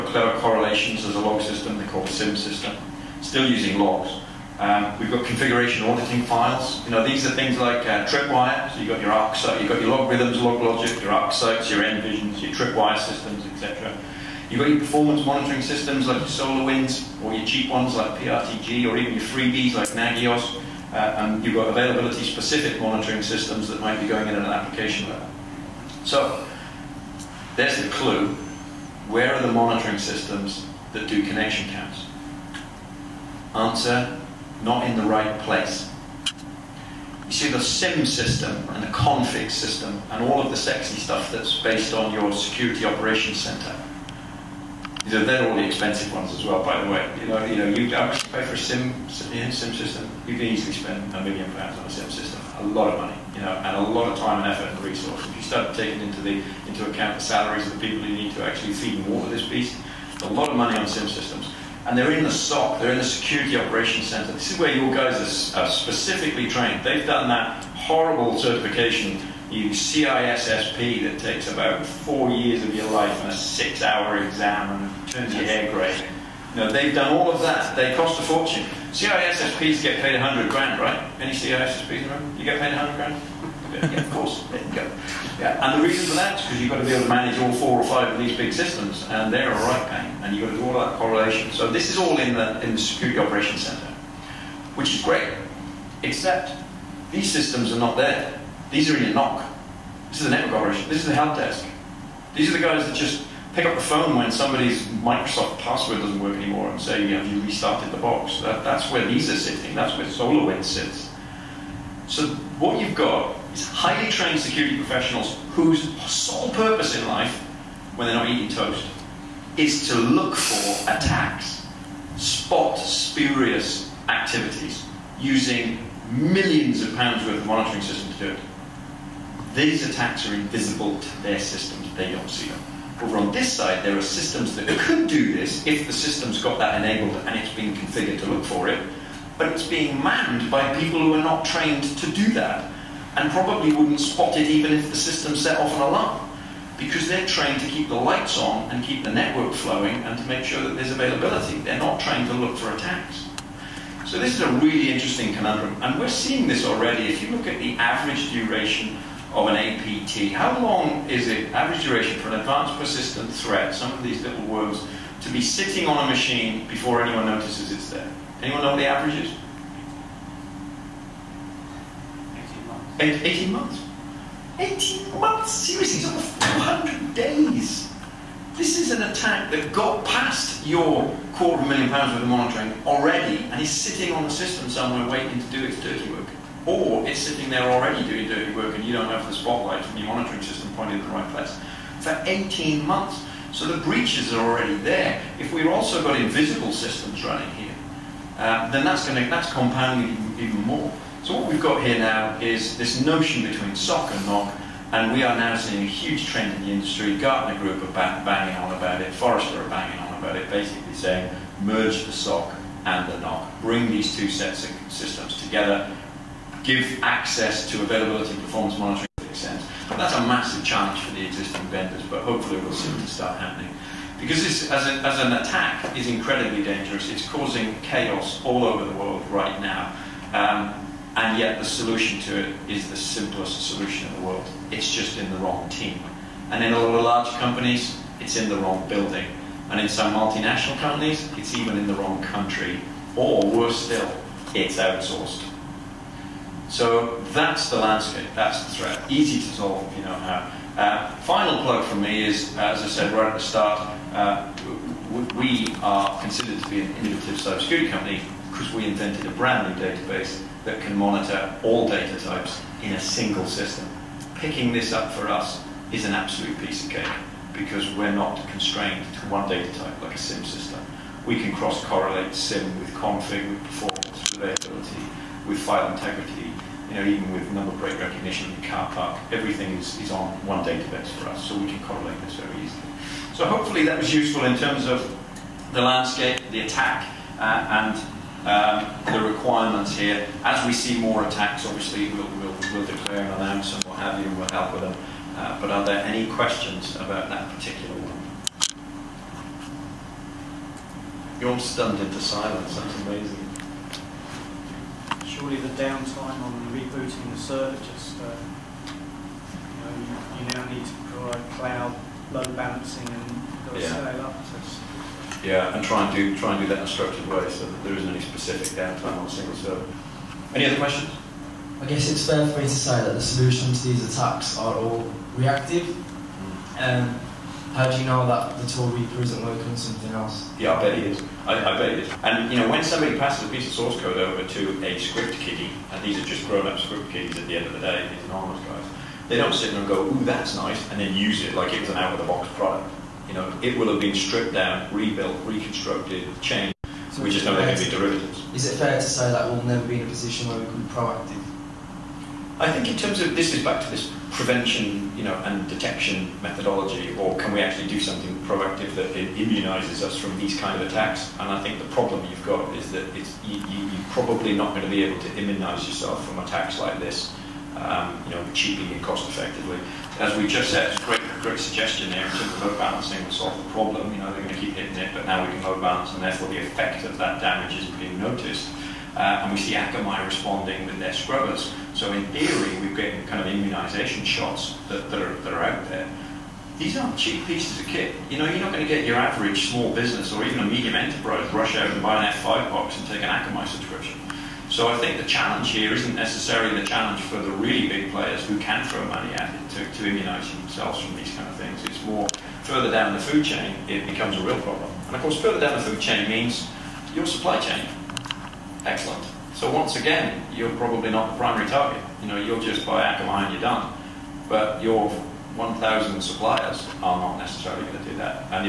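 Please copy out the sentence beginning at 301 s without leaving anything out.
You're all stunned into silence, that's amazing.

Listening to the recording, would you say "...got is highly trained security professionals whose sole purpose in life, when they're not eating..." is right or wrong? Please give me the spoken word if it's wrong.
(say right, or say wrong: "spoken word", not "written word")
right.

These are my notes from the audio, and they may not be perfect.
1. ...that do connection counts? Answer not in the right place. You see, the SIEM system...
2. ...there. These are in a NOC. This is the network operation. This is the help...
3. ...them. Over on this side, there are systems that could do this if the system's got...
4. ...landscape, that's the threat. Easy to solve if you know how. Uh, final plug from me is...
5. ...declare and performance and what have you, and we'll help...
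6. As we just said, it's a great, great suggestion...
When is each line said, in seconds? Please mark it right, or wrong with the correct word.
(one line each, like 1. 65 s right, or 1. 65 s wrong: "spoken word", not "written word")
1. 30 s right
2. 97 s right
3. 132 s right
4. 247 s right
5. 292 s wrong: "announce", not "performance"
6. 370 s right.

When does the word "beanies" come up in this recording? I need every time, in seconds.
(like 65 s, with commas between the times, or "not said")
not said.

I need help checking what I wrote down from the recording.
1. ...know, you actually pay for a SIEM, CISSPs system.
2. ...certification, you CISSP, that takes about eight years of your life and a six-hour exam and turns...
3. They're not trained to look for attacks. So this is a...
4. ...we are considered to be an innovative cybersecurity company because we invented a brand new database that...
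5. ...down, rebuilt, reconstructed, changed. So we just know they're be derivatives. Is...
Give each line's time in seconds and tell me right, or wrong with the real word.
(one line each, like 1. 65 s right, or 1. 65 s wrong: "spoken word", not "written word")
1. 47 s wrong: "SIEM", not "CISSPs"
2. 68 s wrong: "four", not "eight"
3. 151 s right
4. 255 s right
5. 344 s right.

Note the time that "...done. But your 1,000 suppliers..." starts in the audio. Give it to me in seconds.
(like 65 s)
413 s.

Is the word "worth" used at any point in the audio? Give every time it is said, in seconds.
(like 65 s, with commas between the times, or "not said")
127 s, 182 s.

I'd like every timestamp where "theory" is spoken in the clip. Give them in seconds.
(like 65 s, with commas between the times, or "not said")
382 s.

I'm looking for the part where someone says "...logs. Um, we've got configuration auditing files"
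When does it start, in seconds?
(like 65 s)
3 s.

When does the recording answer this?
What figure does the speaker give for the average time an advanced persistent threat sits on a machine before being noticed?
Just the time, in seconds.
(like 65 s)
176 s.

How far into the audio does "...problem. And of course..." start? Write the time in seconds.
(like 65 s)
404 s.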